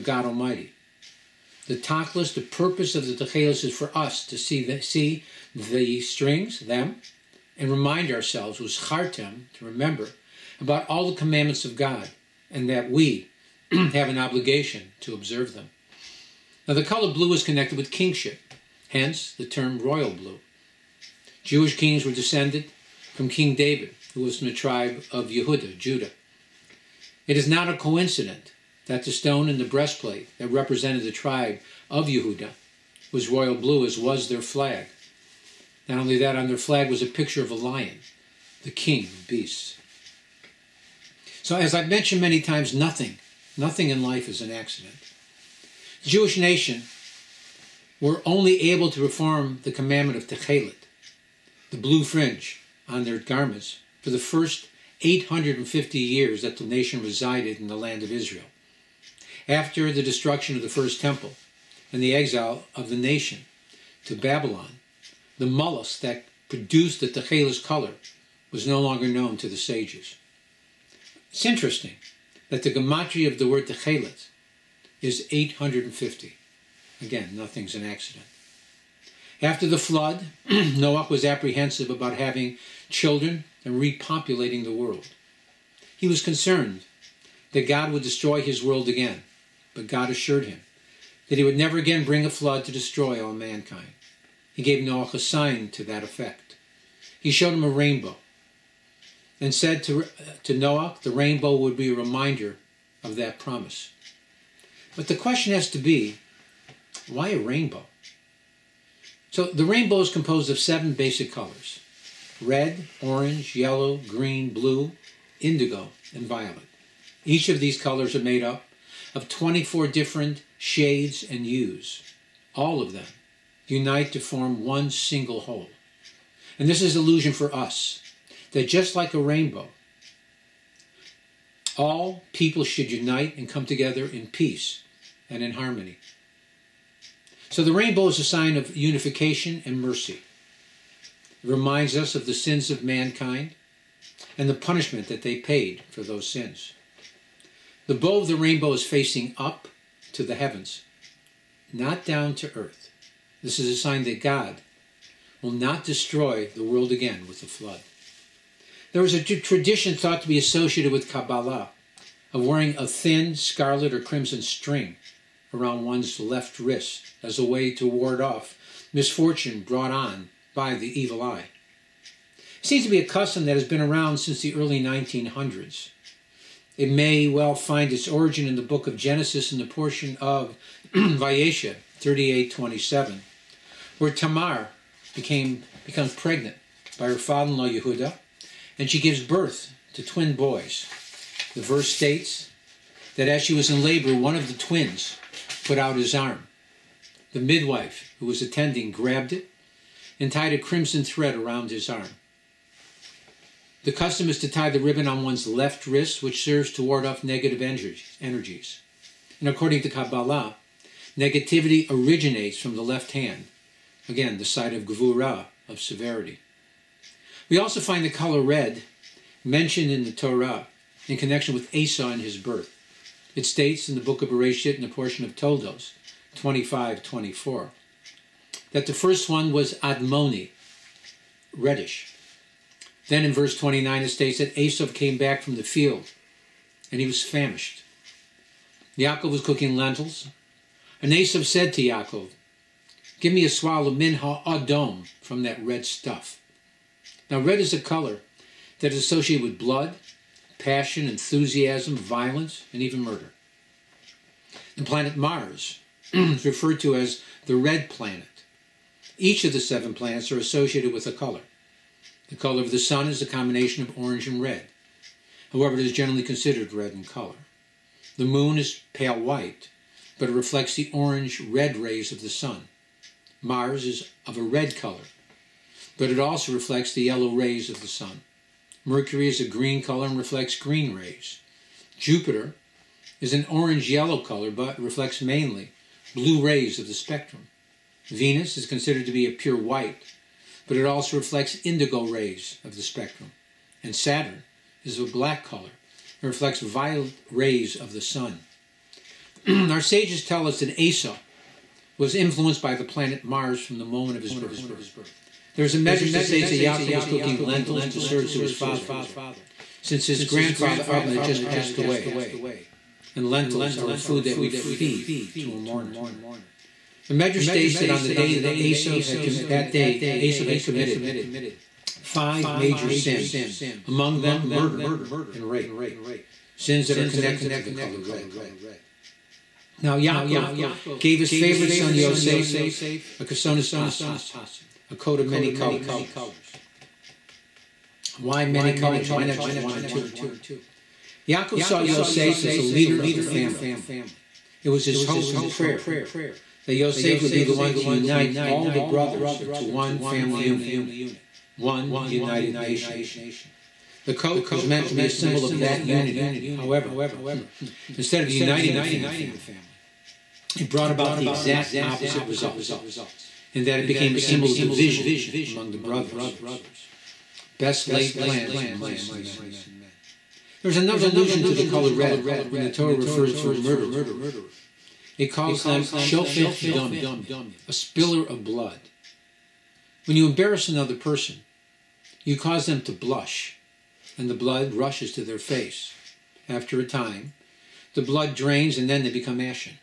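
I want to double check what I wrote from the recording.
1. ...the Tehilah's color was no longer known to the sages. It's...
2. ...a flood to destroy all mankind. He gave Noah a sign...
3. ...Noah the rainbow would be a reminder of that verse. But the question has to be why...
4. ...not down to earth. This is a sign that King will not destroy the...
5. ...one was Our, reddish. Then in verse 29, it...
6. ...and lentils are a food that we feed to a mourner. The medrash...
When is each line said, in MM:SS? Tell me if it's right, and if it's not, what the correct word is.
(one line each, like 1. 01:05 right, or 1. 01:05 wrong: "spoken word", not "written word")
1. 01:06 right
2. 01:32 right
3. 01:40 wrong: "promise", not "verse"
4. 02:31 wrong: "God", not "King"
5. 03:49 wrong: "Admoni", not "Our"
6. 05:13 right.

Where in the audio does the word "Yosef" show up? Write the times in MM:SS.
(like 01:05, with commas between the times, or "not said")
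05:31, 05:41, 05:46.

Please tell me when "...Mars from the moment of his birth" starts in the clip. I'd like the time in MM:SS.
05:03.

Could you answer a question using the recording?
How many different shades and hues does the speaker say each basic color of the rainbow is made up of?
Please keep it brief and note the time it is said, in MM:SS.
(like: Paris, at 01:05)
24, at 01:59.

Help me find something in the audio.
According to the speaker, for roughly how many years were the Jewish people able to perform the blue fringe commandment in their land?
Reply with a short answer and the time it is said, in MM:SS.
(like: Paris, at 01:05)
850, at 00:55.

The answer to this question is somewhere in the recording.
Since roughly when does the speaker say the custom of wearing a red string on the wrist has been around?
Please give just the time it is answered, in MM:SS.
02:54.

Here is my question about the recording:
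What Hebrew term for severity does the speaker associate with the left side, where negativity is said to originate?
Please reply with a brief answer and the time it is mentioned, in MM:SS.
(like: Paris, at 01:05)
Gvura, at 03:34.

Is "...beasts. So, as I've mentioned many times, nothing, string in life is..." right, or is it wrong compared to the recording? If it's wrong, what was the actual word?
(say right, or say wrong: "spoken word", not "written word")
wrong: "nothing", not "string".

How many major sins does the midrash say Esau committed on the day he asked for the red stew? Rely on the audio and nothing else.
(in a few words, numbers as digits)
5.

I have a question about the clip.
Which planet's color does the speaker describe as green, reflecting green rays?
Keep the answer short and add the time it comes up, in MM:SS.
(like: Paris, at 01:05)
Mercury, at 04:38.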